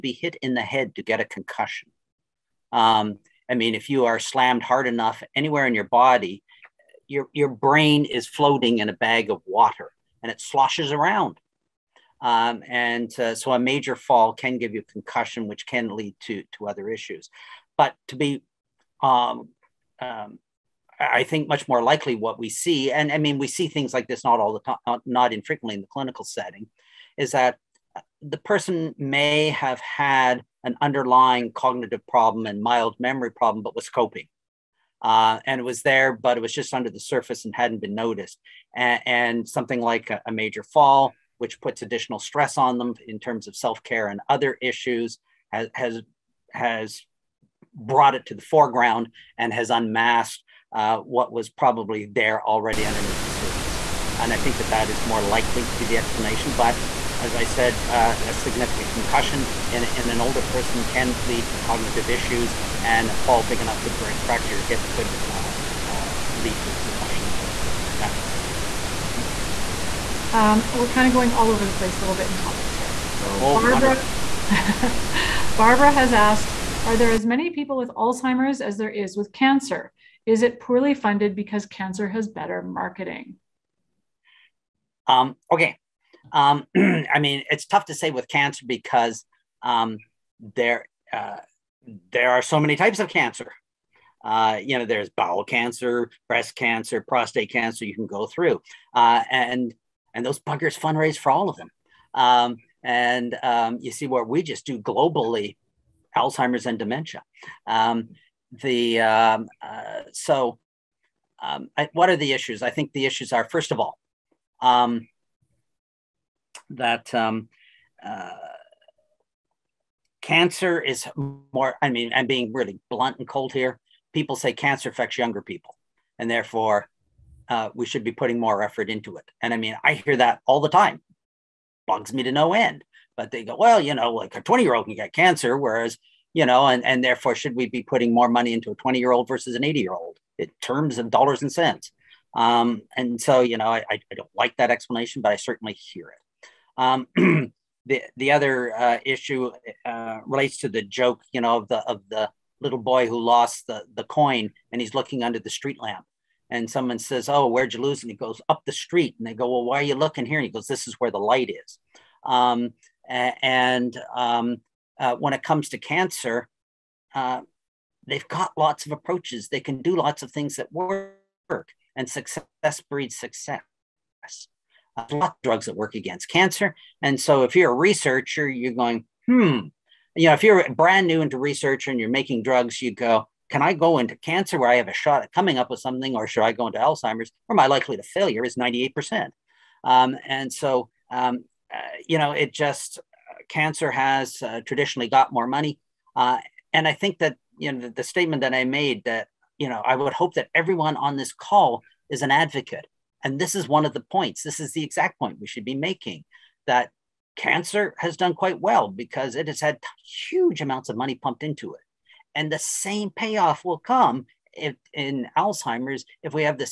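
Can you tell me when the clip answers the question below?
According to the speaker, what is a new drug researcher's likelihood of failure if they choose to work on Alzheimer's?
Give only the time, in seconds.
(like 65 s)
188 s.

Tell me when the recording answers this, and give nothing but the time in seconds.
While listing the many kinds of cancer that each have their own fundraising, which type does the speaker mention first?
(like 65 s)
95 s.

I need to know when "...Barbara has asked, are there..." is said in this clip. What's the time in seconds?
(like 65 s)
75 s.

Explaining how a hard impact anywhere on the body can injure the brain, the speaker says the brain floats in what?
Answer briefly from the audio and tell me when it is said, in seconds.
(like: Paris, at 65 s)
a bag of water, at 8 s.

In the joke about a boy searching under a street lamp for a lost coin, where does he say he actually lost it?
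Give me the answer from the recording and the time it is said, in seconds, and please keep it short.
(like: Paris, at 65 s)
up the street, at 158 s.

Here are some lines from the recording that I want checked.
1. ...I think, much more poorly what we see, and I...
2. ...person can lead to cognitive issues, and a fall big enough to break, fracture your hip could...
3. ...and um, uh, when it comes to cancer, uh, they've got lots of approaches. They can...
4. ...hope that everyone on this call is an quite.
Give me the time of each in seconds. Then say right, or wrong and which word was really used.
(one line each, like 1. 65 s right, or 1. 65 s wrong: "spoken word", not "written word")
1. 20 s wrong: "likely", not "poorly"
2. 60 s right
3. 163 s right
4. 200 s wrong: "advocate", not "quite".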